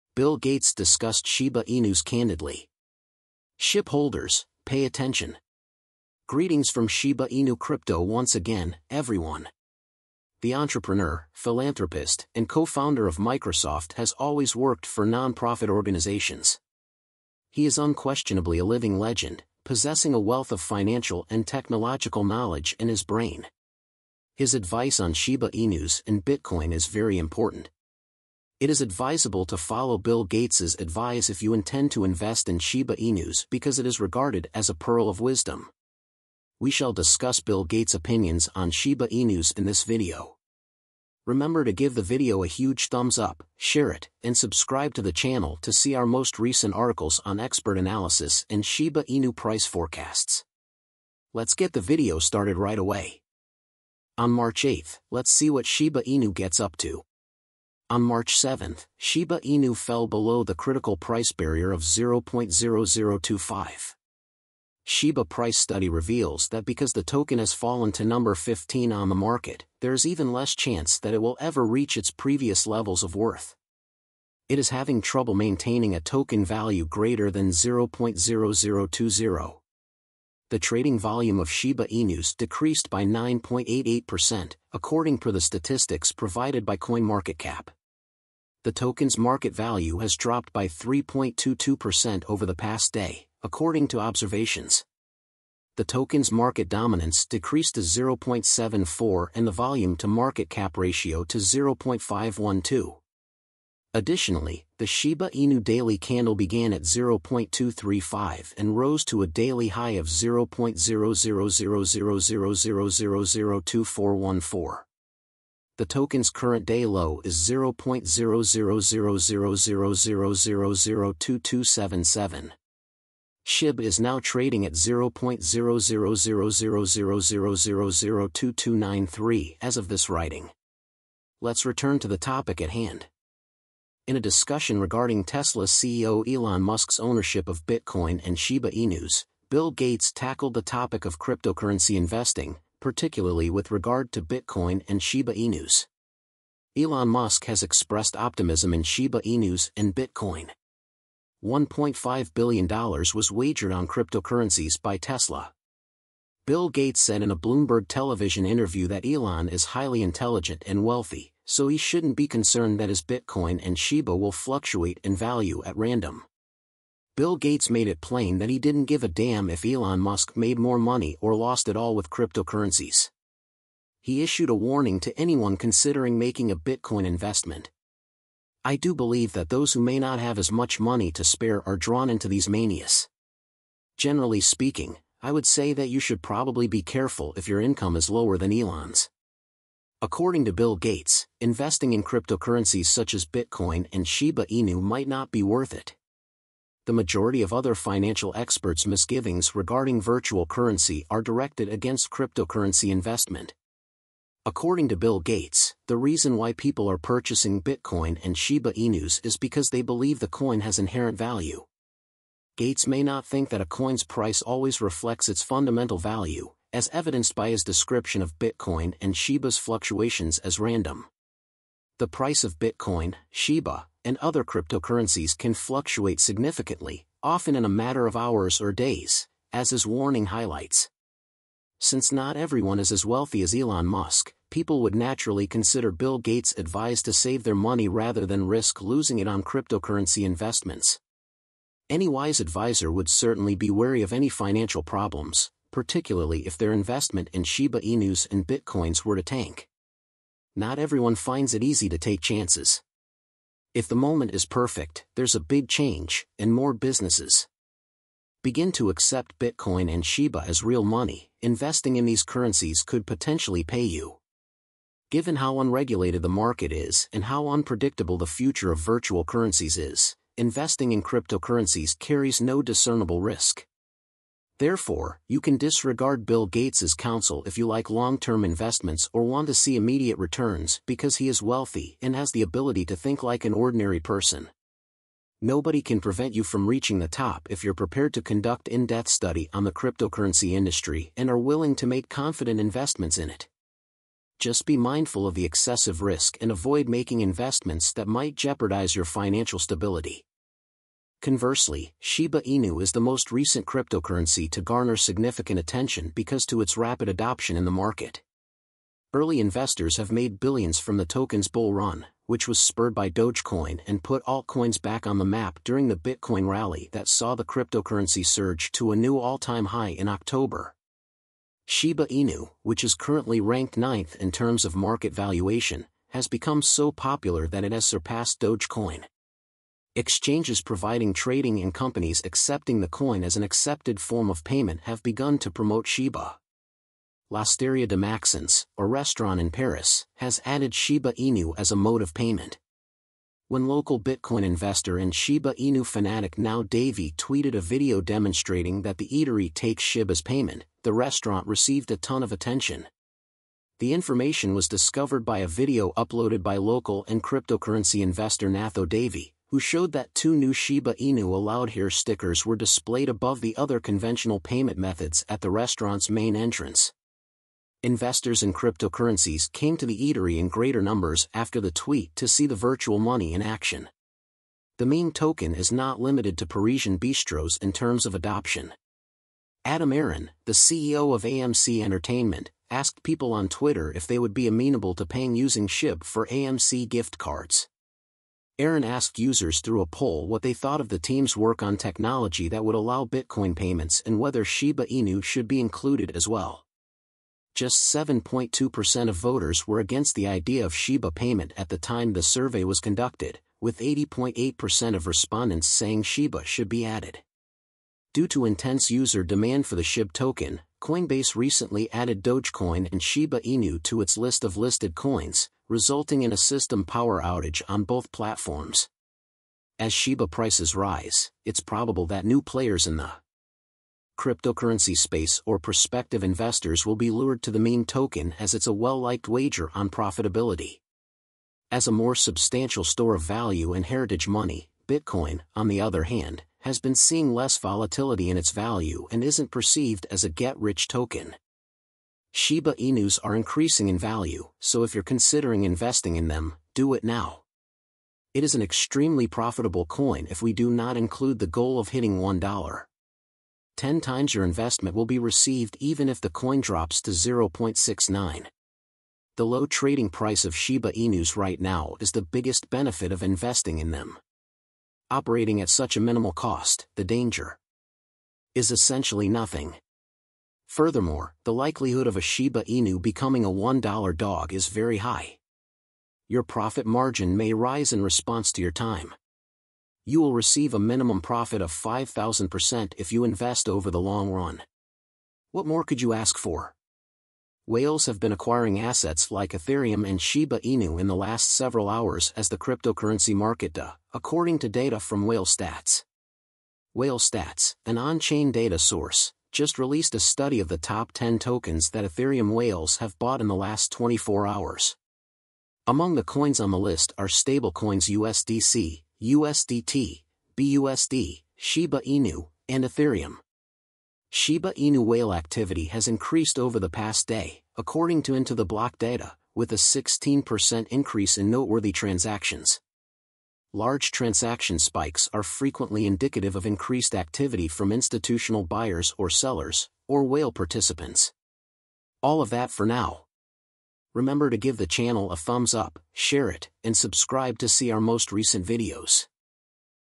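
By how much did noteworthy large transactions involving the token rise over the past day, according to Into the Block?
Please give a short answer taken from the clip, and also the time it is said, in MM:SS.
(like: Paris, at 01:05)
16%, at 08:39.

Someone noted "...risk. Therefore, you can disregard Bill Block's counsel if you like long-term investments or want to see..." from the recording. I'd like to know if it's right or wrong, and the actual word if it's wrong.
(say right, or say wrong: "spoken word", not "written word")
wrong: "Gates", not "Block".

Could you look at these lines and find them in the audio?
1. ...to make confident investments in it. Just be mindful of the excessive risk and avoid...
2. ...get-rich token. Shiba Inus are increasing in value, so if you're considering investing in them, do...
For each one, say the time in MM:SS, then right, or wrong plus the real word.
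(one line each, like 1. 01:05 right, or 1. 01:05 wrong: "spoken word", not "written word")
1. 04:51 right
2. 07:20 right.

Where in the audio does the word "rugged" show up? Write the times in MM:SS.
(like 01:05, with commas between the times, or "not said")
not said.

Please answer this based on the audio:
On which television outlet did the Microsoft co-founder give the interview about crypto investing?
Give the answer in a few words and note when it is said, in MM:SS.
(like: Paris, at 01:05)
Bloomberg, at 02:37.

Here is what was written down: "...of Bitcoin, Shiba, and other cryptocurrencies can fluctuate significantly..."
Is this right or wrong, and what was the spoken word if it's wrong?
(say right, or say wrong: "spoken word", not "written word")
right.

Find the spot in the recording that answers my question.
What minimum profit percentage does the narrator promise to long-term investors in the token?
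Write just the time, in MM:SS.
08:01.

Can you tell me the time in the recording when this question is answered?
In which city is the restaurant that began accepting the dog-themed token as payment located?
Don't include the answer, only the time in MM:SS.
05:39.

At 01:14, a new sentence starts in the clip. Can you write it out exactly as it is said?
It is having trouble maintaining a token value greater than 0.0020.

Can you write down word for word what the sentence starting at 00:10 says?
The entrepreneur, philanthropist, and co-founder of Microsoft has always worked for nonprofit organizations.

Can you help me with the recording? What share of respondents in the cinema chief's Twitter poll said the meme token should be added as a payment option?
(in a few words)
80.8%.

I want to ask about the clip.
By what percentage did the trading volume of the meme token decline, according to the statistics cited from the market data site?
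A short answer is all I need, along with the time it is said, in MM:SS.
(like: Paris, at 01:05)
9.88%, at 01:23.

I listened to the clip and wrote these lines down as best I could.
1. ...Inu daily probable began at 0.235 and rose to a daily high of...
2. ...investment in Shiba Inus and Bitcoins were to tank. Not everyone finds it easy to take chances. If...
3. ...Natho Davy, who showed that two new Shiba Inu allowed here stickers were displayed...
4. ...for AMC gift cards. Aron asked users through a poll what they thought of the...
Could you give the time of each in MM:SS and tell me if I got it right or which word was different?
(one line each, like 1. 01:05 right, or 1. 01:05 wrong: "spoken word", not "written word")
1. 01:45 wrong: "candle", not "probable"
2. 04:06 right
3. 05:58 right
4. 06:26 right.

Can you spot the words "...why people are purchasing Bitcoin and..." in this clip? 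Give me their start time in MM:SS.
03:26.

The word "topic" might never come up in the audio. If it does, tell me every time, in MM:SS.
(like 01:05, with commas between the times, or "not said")
02:12, 02:20.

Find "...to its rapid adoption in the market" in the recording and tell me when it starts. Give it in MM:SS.
05:06.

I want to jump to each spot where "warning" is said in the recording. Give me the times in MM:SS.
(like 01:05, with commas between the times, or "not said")
02:54, 03:49.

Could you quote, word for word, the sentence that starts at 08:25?
Among the coins on the list are stablecoins USDC, USDT, BUSD, Shiba Inu, and Ethereum.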